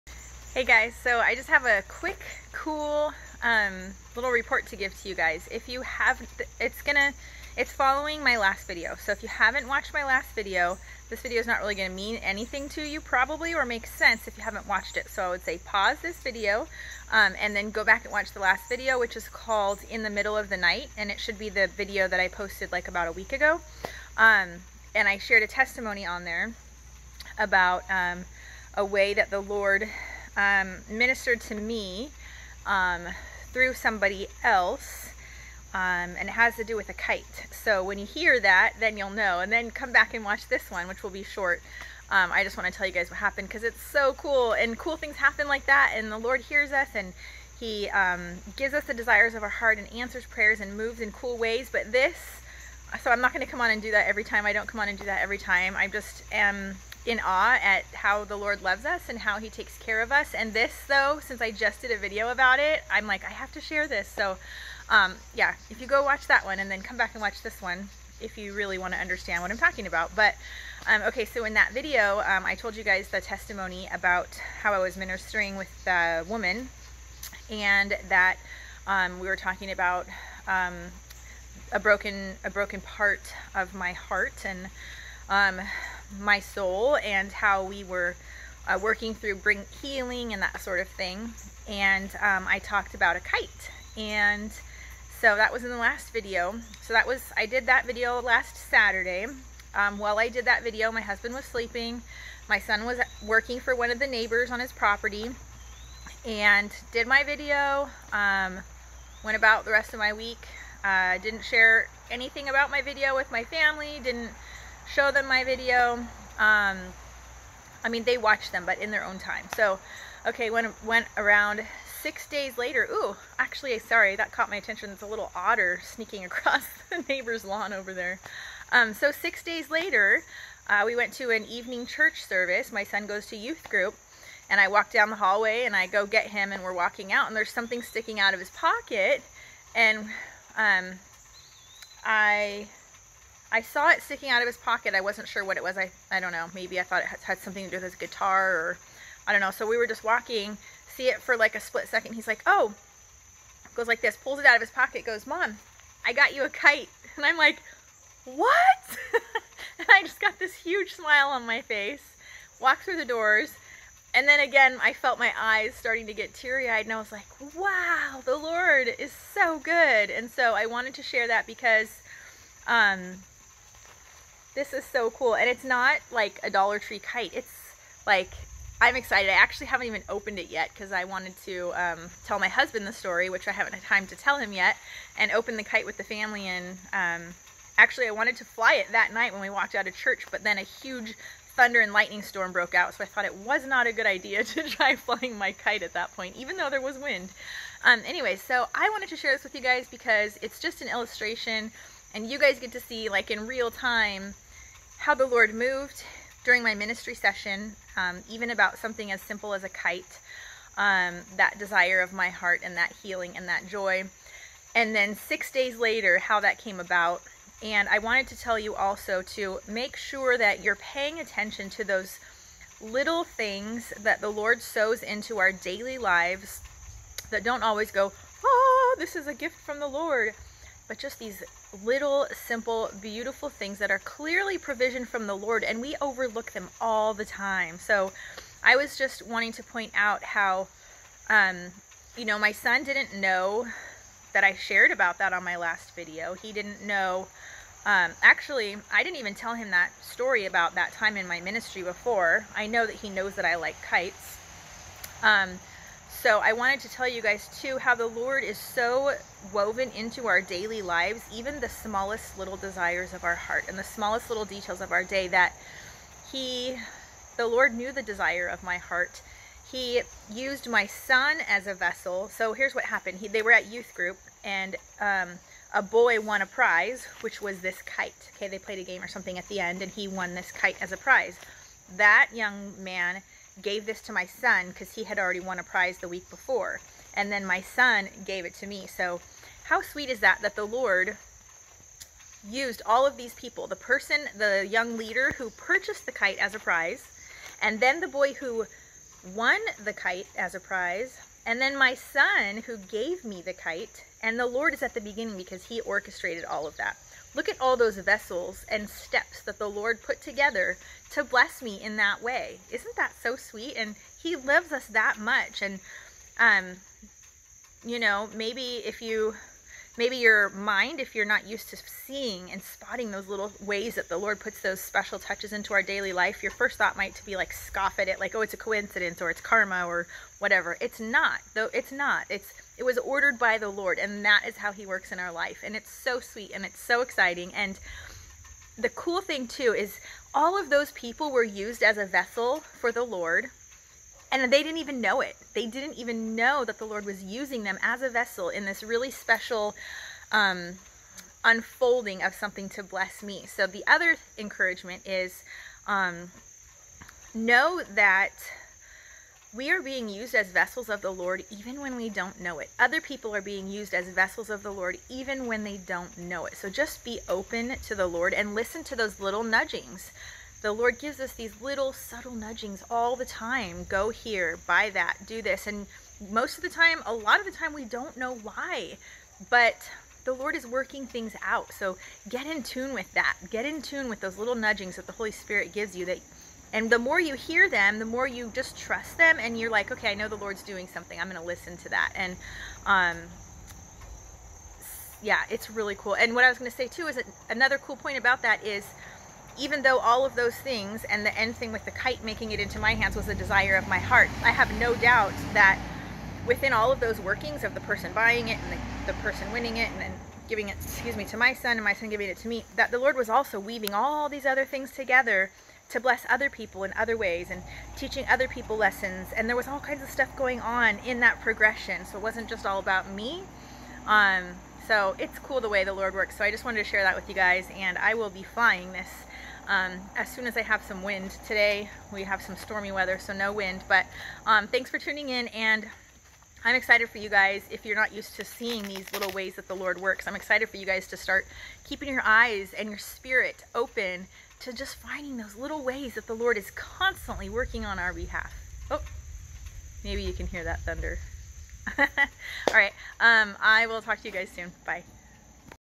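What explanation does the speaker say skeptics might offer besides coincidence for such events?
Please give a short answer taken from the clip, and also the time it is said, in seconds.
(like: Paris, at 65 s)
Karma, at 329 s.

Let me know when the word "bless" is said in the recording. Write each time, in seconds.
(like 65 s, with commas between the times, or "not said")
311 s, 352 s, 415 s.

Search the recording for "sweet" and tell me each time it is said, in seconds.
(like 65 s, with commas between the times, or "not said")
289 s, 313 s, 336 s.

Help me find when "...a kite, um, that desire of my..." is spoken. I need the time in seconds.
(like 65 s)
209 s.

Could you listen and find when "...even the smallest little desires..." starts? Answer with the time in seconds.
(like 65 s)
261 s.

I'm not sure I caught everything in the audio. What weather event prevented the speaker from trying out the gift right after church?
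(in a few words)
Thunder and lightning storm.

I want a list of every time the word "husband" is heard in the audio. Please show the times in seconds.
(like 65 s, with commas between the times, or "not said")
101 s, 182 s.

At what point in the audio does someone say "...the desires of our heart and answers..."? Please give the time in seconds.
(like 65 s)
48 s.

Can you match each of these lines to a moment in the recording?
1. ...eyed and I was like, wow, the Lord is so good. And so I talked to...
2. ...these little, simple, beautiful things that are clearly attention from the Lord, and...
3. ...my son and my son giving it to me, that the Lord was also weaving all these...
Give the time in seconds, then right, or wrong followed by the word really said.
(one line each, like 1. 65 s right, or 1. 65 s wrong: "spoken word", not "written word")
1. 166 s wrong: "wanted", not "talked"
2. 231 s wrong: "provision", not "attention"
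3. 411 s right.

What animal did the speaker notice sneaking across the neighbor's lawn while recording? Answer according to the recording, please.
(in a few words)
Otter.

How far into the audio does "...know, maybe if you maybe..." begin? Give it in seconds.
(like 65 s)
317 s.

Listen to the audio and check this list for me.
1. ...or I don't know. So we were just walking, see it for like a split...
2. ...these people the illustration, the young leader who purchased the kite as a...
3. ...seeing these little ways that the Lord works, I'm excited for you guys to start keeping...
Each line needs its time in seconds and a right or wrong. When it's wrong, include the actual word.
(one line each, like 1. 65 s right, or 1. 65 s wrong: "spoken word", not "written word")
1. 148 s right
2. 293 s wrong: "person", not "illustration"
3. 438 s right.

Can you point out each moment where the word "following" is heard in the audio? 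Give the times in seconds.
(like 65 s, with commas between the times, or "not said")
7 s.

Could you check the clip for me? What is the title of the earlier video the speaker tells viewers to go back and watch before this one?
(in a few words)
In the Middle of the Night.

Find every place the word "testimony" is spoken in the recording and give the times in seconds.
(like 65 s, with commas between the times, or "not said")
25 s, 73 s.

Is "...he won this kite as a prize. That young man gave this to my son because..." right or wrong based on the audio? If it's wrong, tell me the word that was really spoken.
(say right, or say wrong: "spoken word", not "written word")
right.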